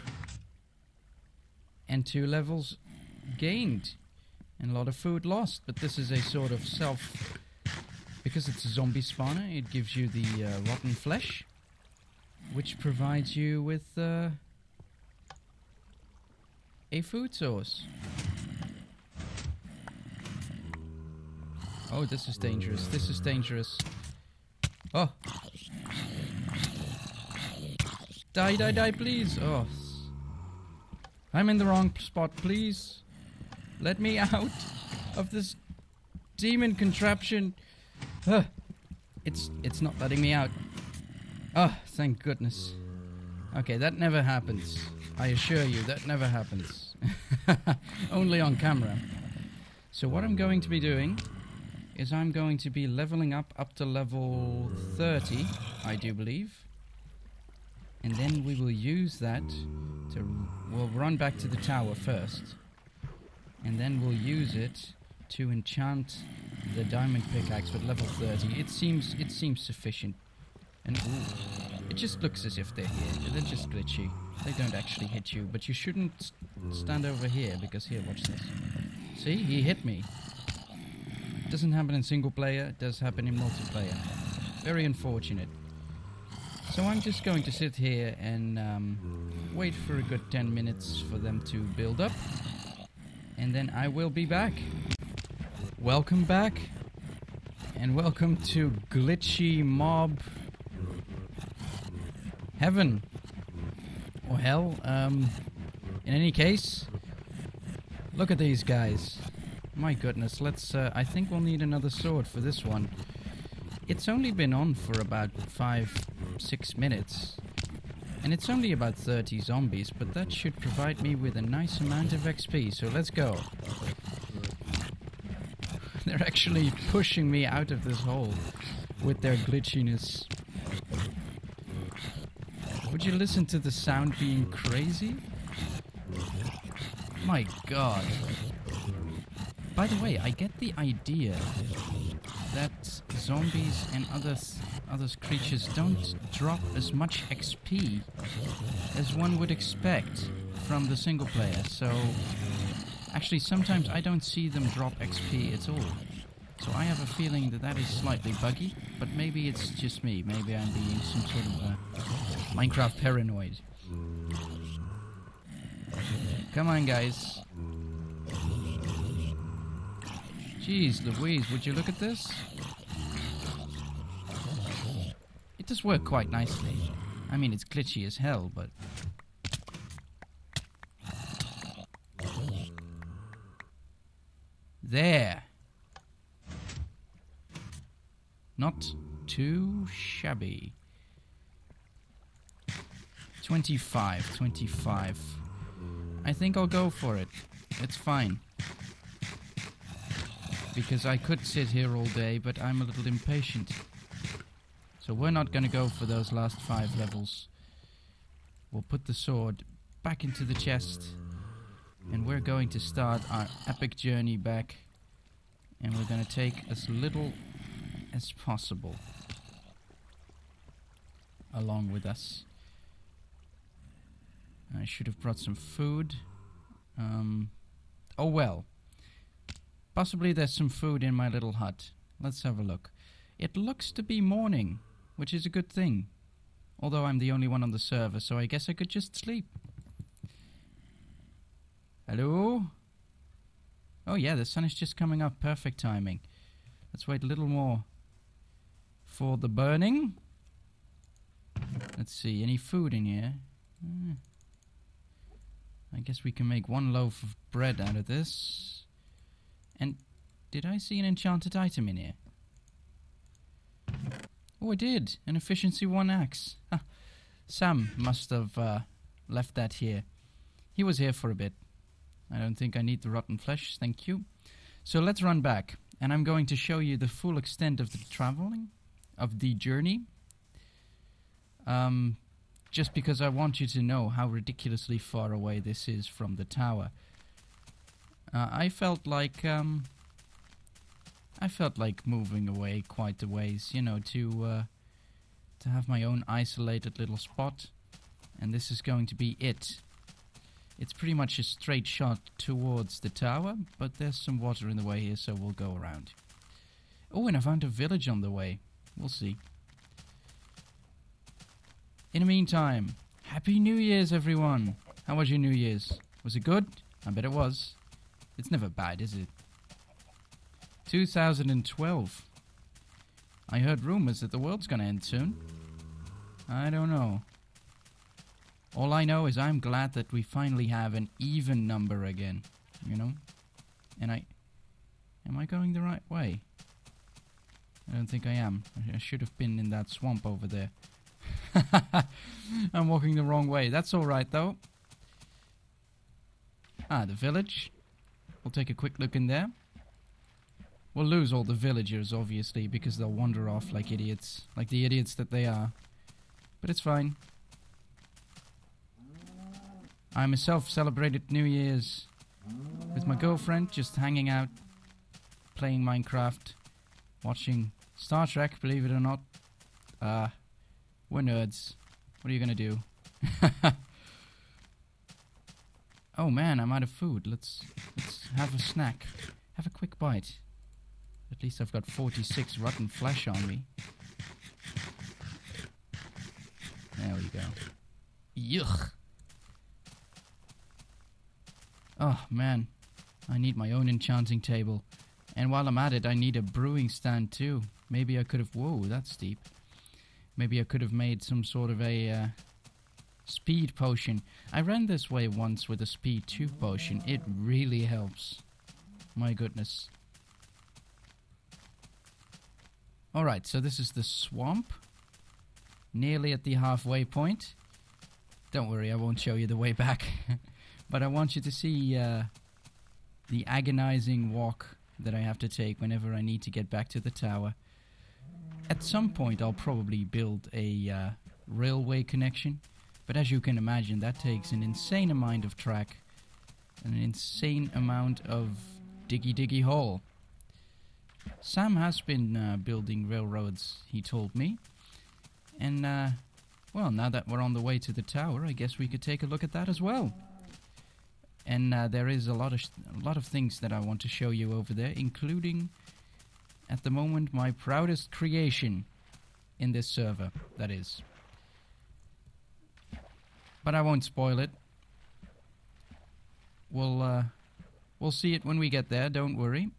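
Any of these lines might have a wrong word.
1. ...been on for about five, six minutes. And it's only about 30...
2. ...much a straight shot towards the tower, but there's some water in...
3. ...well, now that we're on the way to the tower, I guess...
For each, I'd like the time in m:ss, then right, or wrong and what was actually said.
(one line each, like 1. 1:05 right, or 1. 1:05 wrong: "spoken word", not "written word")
1. 1:54 right
2. 5:01 right
3. 7:26 right.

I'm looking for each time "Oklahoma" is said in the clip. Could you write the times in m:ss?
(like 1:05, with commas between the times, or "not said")
not said.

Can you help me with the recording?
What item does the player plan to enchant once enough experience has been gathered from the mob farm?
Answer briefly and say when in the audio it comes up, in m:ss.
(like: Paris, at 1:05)
Diamond pickaxe, at 1:06.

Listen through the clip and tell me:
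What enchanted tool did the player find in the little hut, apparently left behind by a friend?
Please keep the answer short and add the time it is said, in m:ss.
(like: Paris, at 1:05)
Efficiency 1 axe, at 4:25.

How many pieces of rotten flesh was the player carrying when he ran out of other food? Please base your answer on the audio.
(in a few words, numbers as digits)
46.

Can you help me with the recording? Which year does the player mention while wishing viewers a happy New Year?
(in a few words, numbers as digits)
2012.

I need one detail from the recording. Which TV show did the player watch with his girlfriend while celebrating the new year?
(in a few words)
Star Trek.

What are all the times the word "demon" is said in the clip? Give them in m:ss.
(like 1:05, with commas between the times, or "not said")
0:36.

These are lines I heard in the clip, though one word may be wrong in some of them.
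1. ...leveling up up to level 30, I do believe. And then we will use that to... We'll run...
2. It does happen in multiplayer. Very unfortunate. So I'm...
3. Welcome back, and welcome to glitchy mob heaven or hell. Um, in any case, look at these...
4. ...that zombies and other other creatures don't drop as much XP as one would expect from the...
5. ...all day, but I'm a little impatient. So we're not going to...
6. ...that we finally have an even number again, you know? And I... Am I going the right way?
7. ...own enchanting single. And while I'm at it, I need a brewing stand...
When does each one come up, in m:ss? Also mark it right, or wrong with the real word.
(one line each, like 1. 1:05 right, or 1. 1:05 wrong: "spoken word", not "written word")
1. 0:52 right
2. 1:22 right
3. 1:35 right
4. 2:22 right
5. 3:21 right
6. 5:29 right
7. 6:33 wrong: "table", not "single".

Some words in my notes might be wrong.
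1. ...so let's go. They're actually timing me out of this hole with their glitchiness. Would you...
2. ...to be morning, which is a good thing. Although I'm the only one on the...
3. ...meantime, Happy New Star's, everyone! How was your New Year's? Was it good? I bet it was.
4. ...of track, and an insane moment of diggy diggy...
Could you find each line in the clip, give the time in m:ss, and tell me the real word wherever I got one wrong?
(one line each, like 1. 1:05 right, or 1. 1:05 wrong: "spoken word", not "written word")
1. 2:02 wrong: "pushing", not "timing"
2. 3:53 right
3. 5:12 wrong: "Year", not "Star"
4. 7:15 wrong: "amount", not "moment".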